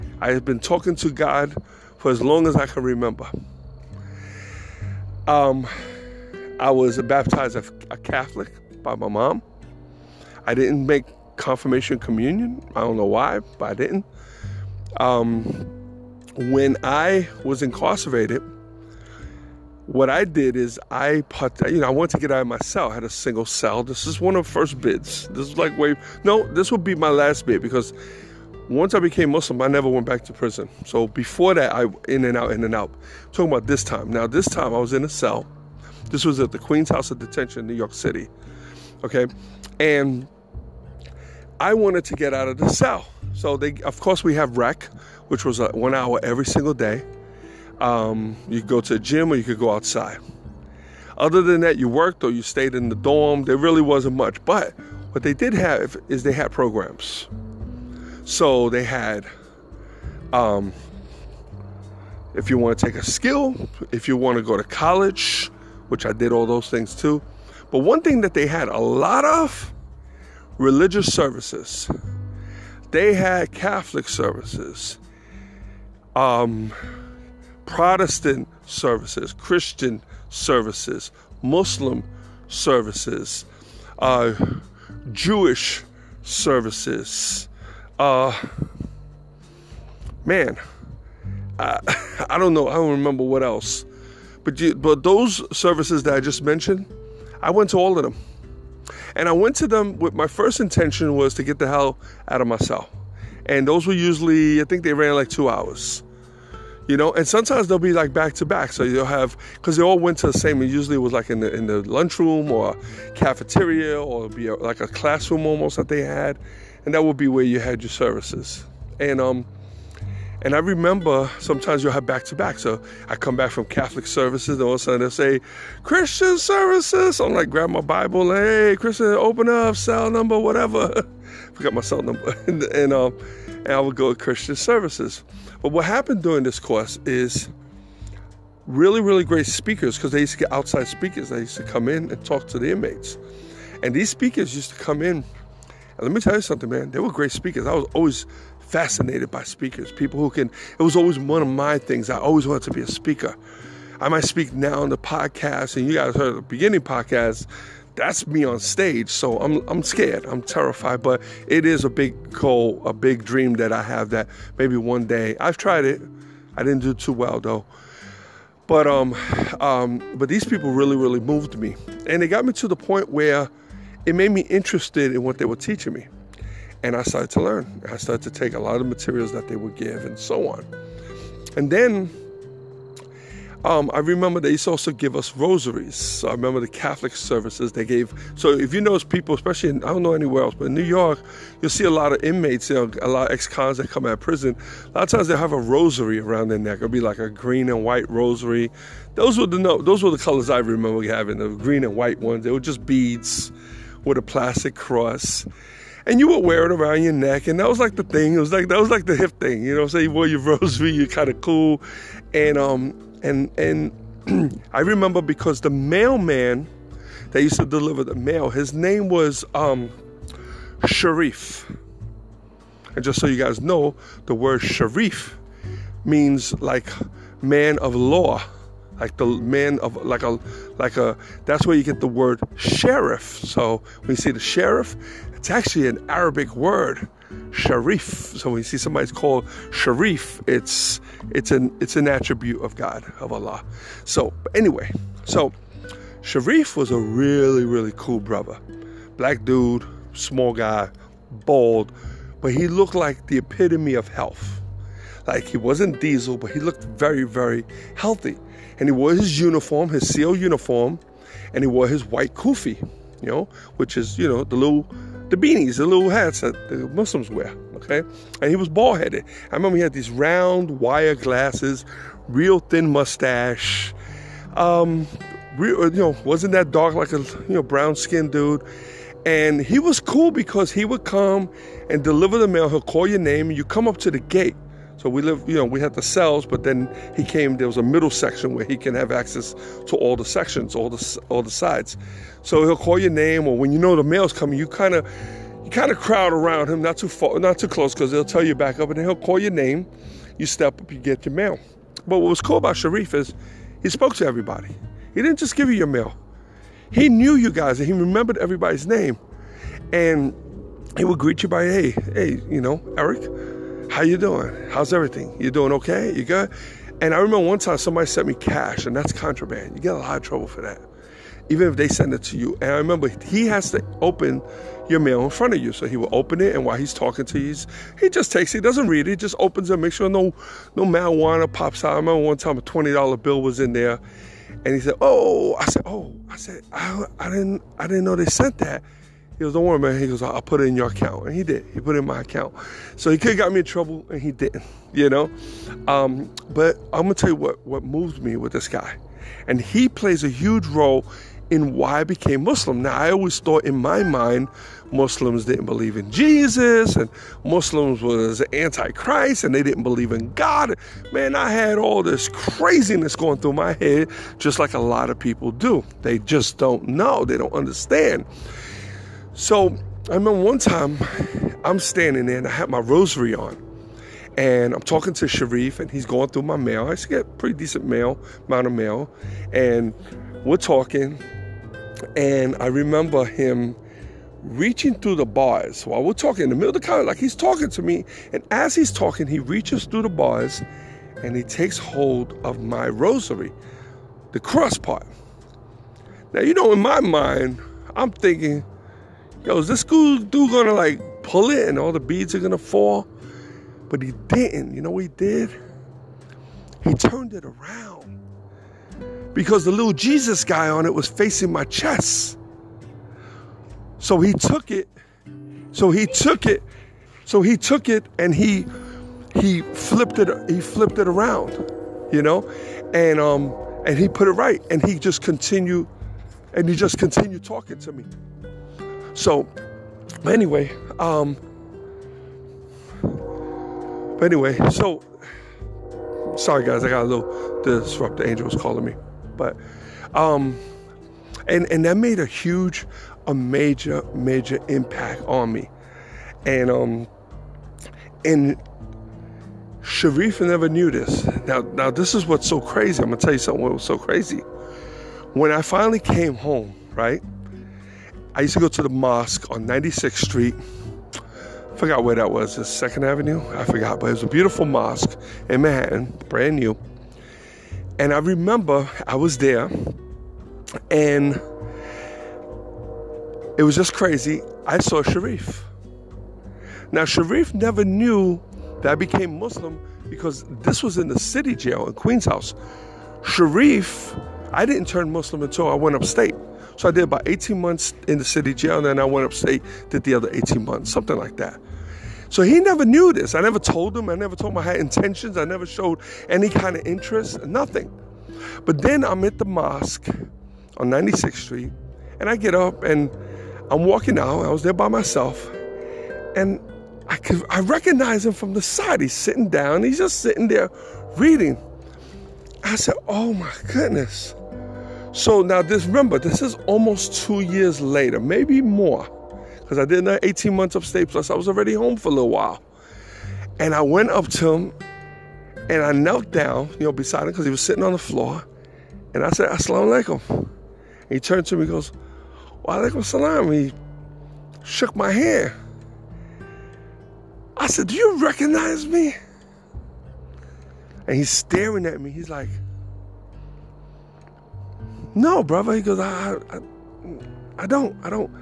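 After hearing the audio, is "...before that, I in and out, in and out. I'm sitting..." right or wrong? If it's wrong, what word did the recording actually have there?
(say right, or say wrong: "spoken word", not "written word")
wrong: "talking", not "sitting".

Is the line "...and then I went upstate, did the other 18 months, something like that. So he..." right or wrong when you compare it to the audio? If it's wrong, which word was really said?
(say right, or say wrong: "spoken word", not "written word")
right.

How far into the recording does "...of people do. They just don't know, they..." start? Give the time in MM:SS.
06:05.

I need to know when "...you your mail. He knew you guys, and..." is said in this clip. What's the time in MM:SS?
05:05.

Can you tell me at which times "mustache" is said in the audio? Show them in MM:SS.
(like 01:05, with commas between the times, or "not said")
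04:32.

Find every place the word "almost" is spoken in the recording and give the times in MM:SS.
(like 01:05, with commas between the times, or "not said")
01:55, 08:36.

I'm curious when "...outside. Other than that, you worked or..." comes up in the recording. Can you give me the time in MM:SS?
00:49.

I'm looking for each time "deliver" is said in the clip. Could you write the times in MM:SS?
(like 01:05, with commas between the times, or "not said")
03:37, 04:42.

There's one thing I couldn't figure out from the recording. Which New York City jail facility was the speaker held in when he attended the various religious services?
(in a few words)
Queen's House of Detention.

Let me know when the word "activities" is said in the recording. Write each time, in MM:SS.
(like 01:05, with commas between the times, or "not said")
not said.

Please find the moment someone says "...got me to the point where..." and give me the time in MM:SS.
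02:52.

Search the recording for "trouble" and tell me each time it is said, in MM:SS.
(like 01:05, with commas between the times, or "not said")
05:20, 05:43.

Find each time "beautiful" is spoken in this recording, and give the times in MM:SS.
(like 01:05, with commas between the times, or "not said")
07:44.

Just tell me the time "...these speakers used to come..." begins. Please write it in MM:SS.
02:23.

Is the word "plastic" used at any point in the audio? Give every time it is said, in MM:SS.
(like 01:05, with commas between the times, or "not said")
03:24.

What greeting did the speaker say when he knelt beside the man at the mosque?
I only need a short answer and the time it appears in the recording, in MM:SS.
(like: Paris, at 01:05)
Assalamu alaikum, at 08:49.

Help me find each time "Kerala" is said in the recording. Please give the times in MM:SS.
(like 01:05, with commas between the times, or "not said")
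not said.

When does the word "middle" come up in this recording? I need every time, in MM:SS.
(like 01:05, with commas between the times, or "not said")
04:47, 06:26.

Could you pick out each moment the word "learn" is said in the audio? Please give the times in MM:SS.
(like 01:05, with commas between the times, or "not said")
02:57.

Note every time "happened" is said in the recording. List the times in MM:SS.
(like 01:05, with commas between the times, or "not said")
02:15.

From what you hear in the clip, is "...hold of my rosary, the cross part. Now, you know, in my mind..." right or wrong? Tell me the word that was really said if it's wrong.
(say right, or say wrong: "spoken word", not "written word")
right.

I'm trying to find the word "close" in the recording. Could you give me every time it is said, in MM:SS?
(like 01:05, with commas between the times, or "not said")
04:57.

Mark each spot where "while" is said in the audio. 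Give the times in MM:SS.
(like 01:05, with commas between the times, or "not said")
05:26, 06:25, 08:42.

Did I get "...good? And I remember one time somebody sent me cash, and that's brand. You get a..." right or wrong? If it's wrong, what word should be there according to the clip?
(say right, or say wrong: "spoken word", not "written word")
wrong: "contraband", not "brand".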